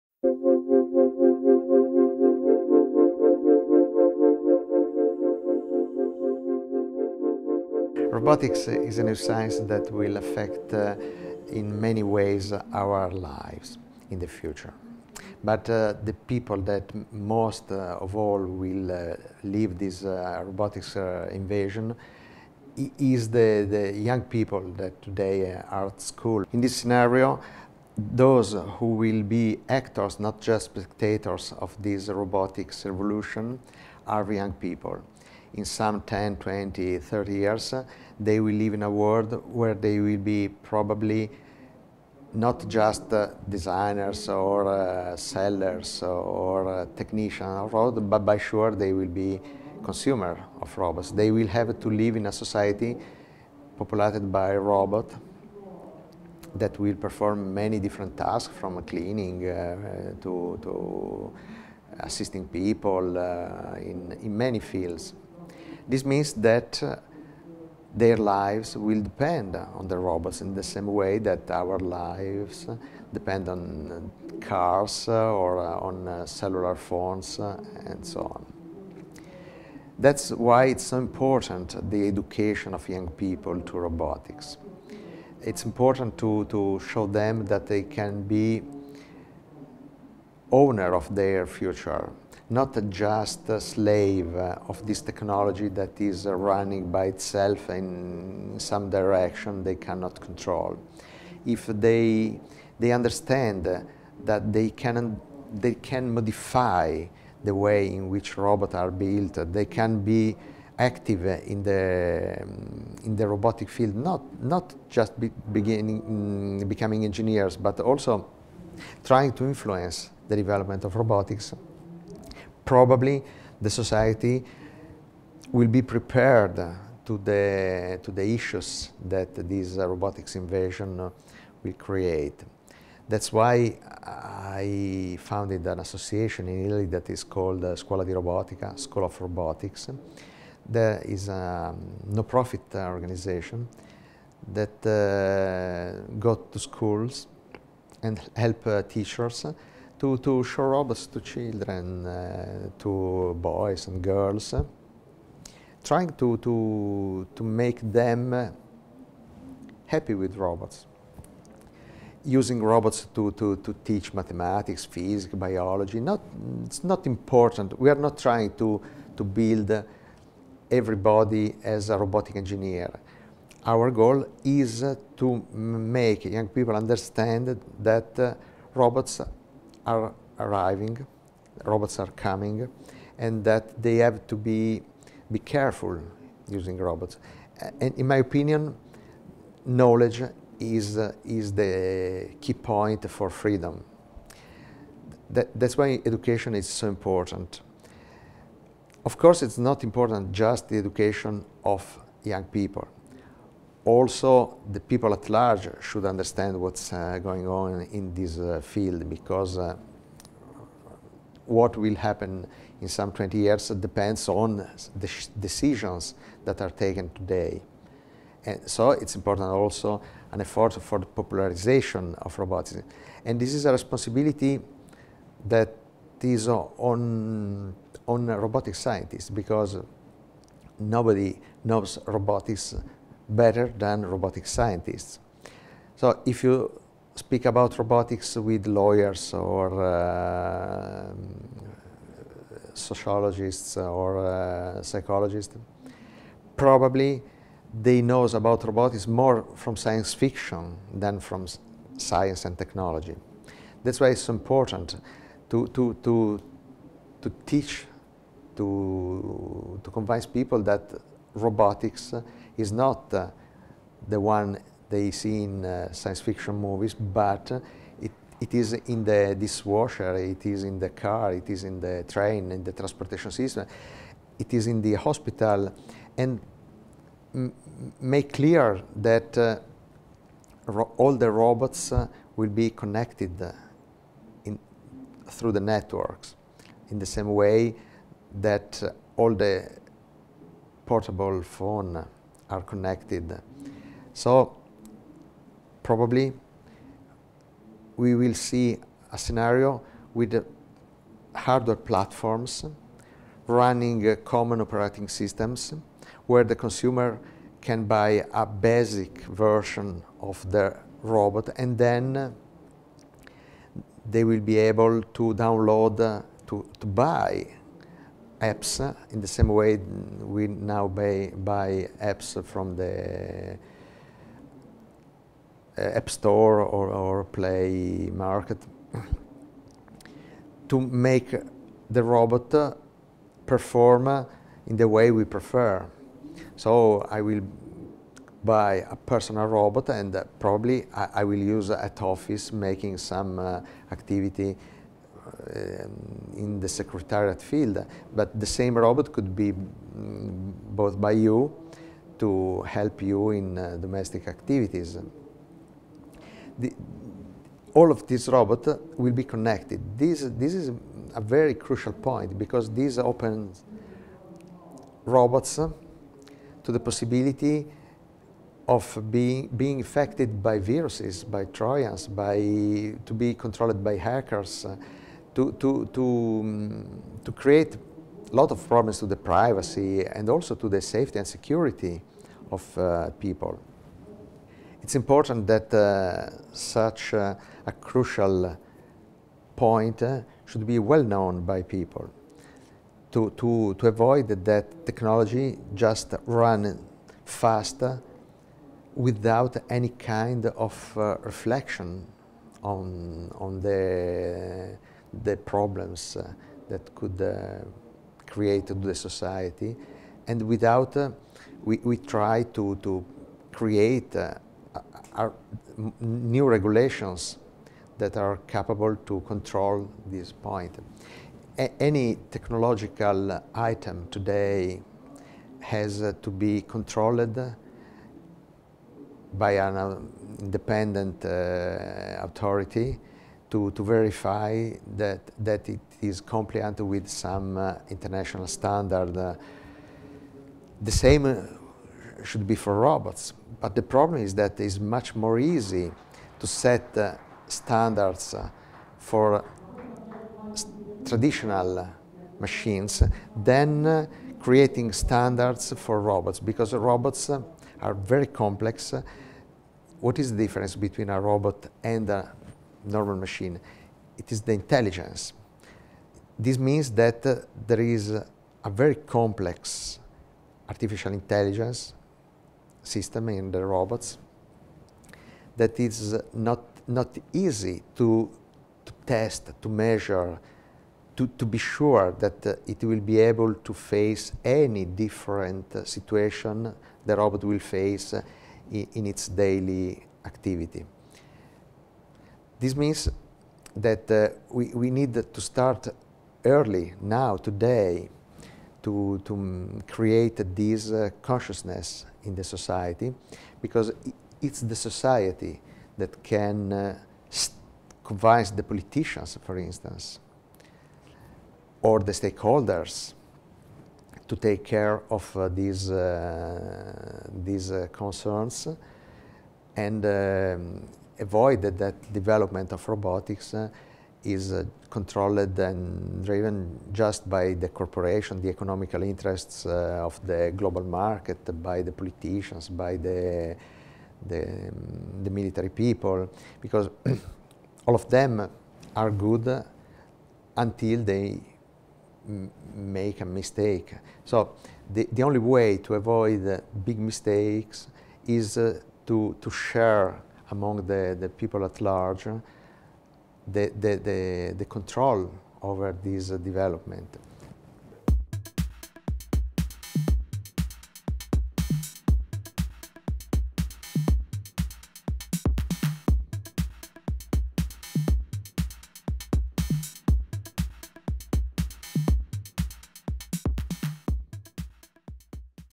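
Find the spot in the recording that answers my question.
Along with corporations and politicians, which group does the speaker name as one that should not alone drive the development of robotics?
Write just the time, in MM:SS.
08:55.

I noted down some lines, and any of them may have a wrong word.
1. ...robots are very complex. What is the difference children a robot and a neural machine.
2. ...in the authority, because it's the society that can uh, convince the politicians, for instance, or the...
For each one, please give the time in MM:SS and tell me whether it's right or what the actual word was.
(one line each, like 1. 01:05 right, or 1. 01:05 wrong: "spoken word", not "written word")
1. 07:36 wrong: "between", not "children"
2. 08:22 wrong: "society", not "authority".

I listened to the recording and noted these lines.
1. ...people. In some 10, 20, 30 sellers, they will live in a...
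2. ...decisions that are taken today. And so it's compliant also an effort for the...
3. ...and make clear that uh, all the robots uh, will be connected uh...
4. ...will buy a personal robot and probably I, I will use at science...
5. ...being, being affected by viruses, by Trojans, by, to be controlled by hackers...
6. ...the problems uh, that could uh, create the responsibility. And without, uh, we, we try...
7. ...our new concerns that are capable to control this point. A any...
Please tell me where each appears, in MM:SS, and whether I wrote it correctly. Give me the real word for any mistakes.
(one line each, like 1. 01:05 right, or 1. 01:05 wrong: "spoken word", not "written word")
1. 00:34 wrong: "years", not "sellers"
2. 03:35 wrong: "important", not "compliant"
3. 04:36 right
4. 05:37 wrong: "office", not "science"
5. 06:09 right
6. 06:45 wrong: "society", not "responsibility"
7. 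06:55 wrong: "regulations", not "concerns".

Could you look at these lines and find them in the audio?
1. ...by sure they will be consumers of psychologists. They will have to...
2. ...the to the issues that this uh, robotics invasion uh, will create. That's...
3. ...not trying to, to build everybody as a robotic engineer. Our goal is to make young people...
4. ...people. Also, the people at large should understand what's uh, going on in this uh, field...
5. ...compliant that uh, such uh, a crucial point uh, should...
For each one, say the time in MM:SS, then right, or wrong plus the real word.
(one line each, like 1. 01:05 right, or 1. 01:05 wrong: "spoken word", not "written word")
1. 00:48 wrong: "robots", not "psychologists"
2. 02:07 right
3. 02:47 right
4. 03:22 right
5. 06:24 wrong: "important", not "compliant".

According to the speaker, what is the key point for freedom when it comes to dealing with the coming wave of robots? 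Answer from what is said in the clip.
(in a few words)
Knowledge.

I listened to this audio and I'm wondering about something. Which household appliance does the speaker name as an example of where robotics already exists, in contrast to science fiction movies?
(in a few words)
Dishwasher.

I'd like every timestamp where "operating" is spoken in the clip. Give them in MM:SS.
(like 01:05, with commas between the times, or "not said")
05:04.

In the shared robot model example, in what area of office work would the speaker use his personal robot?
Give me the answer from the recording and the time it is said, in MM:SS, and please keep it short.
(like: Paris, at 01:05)
Secretariat, at 05:46.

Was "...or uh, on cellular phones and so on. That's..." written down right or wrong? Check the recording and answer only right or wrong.
right.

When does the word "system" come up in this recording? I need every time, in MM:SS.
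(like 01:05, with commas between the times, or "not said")
04:33, 05:05, 07:52.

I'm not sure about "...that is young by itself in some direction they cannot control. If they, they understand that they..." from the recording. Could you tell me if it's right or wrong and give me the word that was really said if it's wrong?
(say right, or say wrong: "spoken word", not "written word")
wrong: "running", not "young".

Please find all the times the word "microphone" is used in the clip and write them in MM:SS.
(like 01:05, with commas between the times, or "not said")
not said.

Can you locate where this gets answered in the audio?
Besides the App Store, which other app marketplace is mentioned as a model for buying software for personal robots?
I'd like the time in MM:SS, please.
05:27.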